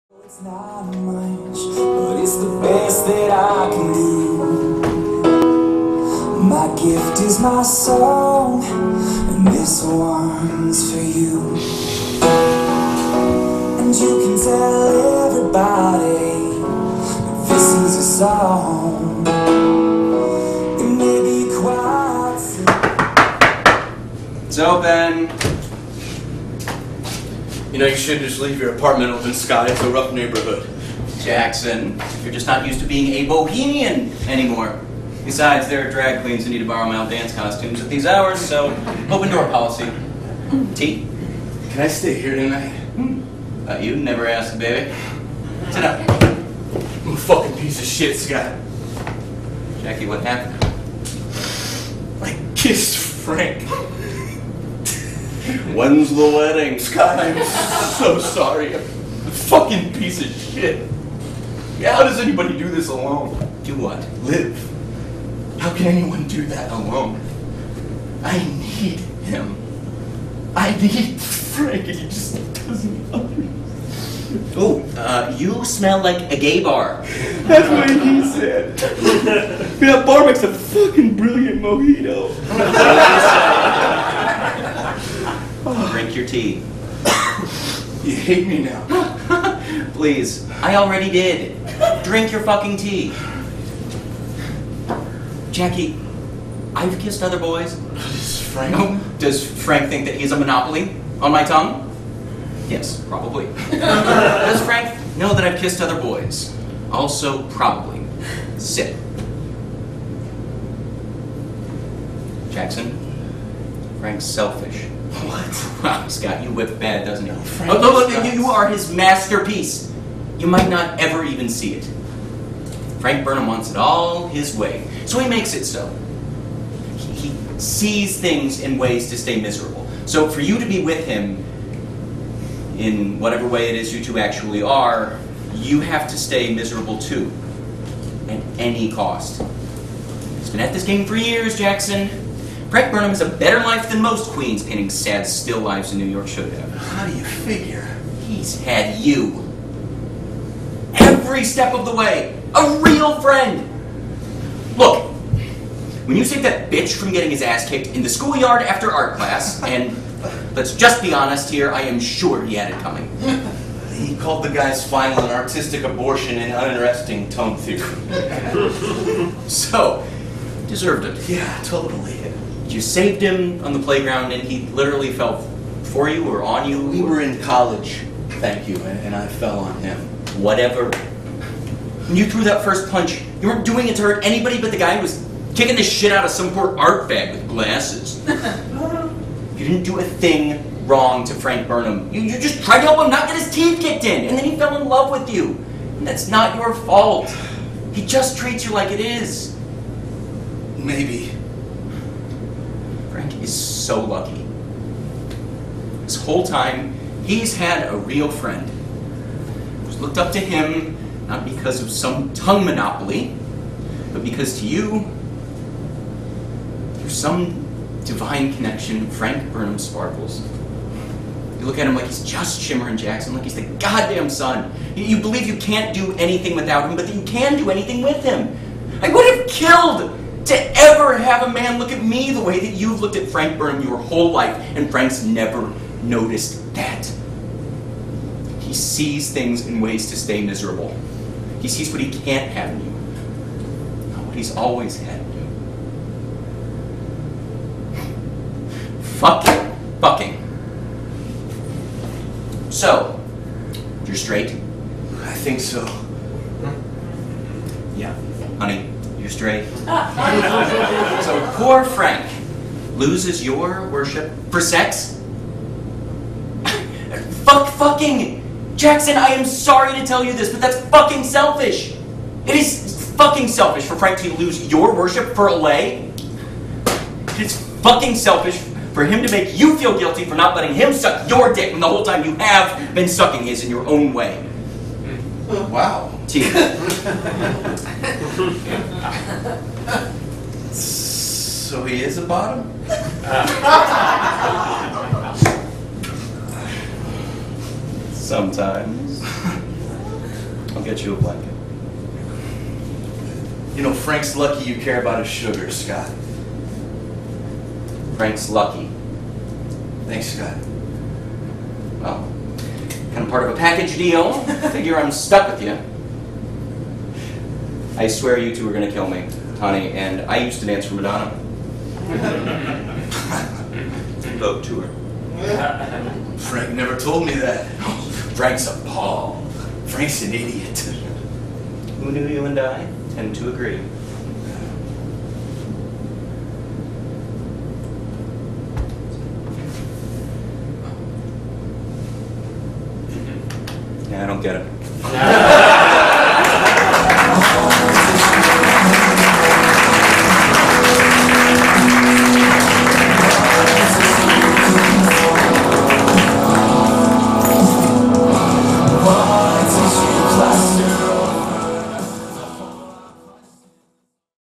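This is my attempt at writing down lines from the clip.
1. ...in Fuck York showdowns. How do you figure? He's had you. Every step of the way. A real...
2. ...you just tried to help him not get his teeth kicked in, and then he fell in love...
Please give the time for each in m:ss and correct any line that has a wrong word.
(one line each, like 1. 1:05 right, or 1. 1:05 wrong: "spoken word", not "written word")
1. 2:25 wrong: "New", not "Fuck"
2. 3:12 right.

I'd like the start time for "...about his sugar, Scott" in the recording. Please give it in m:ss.
5:05.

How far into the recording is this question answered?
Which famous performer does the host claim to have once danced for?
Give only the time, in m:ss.
5:20.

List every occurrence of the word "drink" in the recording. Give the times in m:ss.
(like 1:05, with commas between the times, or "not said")
1:25, 1:32.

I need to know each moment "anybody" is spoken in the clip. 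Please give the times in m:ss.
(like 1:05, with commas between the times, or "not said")
1:02, 3:04.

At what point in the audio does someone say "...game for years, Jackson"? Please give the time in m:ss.
2:20.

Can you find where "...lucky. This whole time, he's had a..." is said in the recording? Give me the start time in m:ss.
3:24.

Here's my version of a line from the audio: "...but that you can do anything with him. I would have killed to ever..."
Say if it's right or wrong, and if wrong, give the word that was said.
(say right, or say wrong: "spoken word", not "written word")
right.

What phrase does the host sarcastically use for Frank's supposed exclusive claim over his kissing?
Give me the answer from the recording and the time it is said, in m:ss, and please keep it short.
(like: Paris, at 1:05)
Tongue monopoly, at 1:40.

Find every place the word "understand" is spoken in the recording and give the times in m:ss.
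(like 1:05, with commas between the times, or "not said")
1:13.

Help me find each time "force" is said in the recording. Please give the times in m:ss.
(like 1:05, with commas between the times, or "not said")
not said.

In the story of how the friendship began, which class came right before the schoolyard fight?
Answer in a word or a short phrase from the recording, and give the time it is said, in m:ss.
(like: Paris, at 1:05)
Art class, at 2:38.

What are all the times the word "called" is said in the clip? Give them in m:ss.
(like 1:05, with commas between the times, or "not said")
2:44.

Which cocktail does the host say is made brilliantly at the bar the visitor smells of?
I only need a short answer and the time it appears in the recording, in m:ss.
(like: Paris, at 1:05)
Mojito, at 1:21.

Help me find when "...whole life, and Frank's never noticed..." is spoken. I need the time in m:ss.
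3:53.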